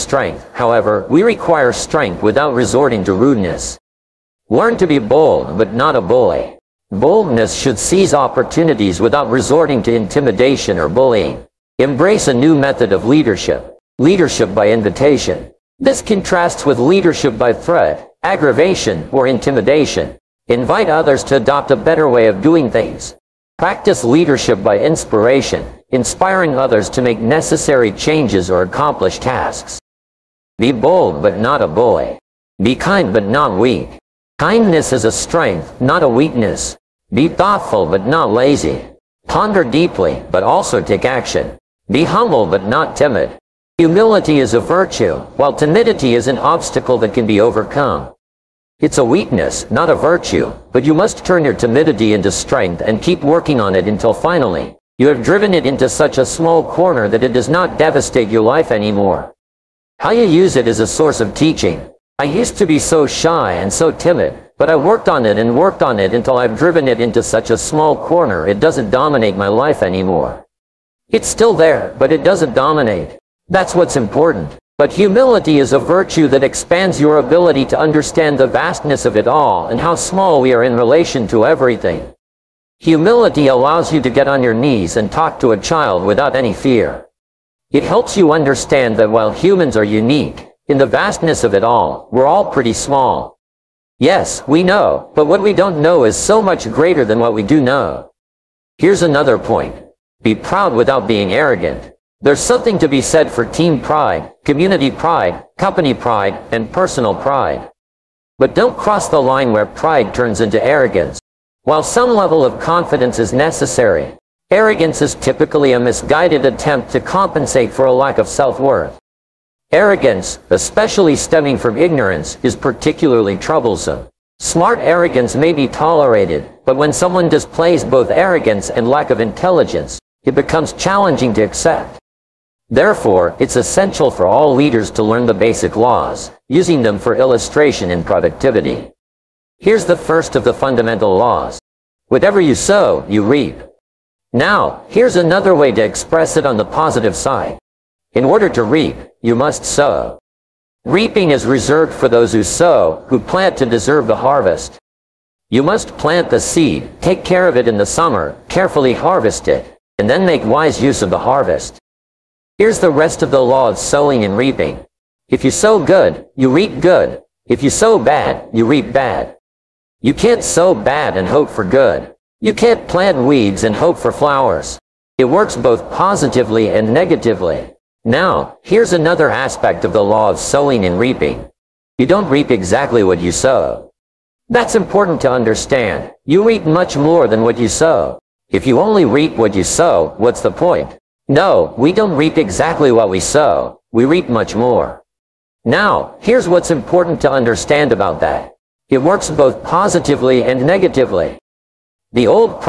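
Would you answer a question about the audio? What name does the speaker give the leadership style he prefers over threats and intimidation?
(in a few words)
Leadership by invitation.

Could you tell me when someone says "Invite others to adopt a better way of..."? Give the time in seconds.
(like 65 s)
20 s.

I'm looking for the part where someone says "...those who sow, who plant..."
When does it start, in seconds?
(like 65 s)
152 s.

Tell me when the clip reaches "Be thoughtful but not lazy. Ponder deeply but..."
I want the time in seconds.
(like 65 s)
37 s.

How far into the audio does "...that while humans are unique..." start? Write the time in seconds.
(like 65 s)
88 s.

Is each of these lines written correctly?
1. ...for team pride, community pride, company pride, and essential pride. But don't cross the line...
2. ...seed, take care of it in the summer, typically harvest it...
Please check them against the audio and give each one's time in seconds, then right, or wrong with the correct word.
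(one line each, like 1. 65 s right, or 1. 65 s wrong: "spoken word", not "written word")
1. 103 s wrong: "personal", not "essential"
2. 156 s wrong: "carefully", not "typically".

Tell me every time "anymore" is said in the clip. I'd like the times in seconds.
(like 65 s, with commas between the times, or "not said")
58 s, 69 s.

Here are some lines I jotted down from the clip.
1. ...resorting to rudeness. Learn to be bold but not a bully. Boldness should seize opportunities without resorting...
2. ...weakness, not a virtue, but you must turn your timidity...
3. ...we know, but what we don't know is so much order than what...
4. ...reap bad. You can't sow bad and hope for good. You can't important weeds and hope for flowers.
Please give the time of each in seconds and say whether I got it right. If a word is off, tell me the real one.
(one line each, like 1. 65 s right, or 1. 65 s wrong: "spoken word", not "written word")
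1. 2 s right
2. 49 s right
3. 94 s wrong: "greater", not "order"
4. 168 s wrong: "plant", not "important".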